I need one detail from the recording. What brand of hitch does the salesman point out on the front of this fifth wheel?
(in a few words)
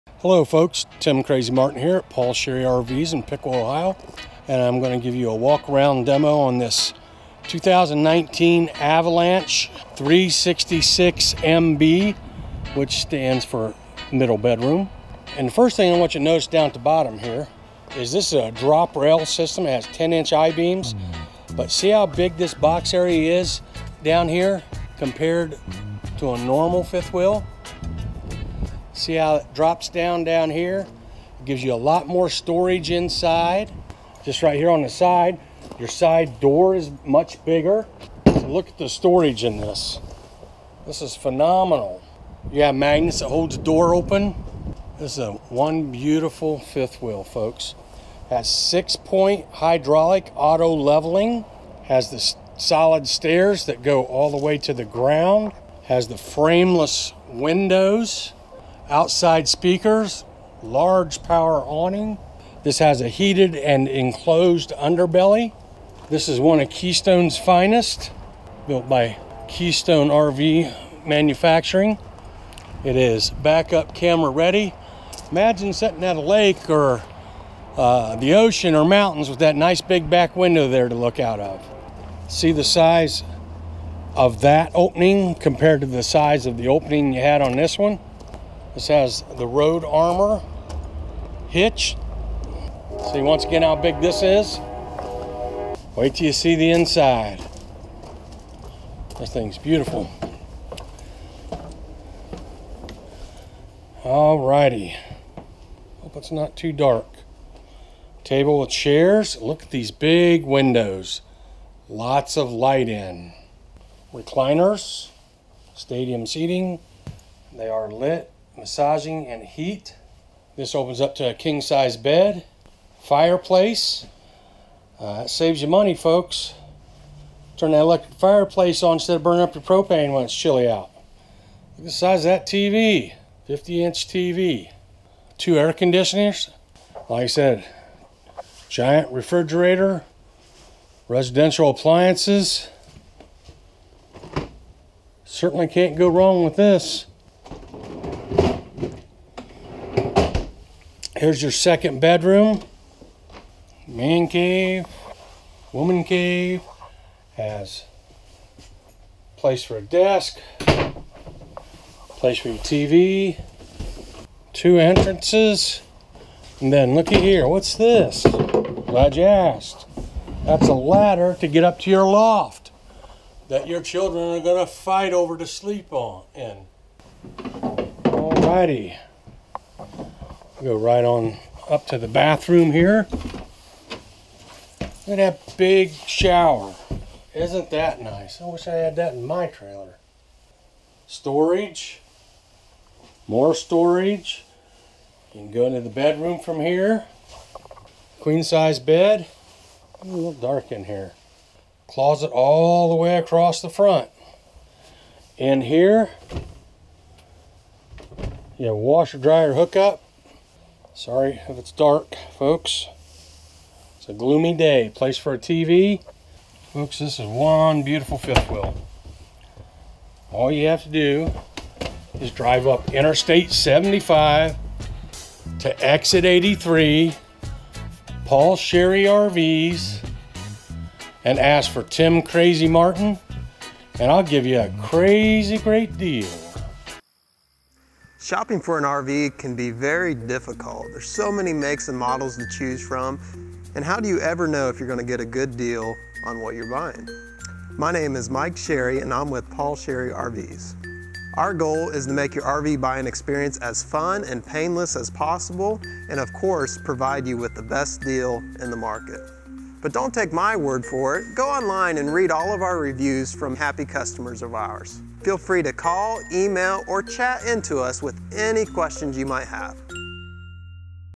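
Road Armor.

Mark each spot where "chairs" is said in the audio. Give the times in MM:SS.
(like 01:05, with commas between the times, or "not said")
01:48.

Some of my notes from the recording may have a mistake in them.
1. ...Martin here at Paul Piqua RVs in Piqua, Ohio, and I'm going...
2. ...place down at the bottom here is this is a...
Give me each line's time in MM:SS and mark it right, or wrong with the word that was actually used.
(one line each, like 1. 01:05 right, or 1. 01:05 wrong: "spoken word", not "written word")
1. 00:01 wrong: "Sherry", not "Piqua"
2. 00:16 wrong: "notice", not "place".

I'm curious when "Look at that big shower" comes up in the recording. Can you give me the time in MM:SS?
03:04.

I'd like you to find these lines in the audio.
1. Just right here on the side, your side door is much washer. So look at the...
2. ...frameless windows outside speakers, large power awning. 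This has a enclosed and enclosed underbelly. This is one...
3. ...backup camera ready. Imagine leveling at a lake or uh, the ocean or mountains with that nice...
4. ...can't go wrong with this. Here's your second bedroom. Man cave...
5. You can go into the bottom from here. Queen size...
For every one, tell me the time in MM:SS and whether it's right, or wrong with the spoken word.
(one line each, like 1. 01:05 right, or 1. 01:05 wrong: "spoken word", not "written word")
1. 00:34 wrong: "bigger", not "washer"
2. 00:56 wrong: "heated", not "enclosed"
3. 01:13 wrong: "sitting", not "leveling"
4. 02:25 right
5. 03:15 wrong: "bedroom", not "bottom".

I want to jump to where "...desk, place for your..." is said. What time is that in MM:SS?
02:39.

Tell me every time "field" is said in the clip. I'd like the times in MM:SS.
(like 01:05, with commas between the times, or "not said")
not said.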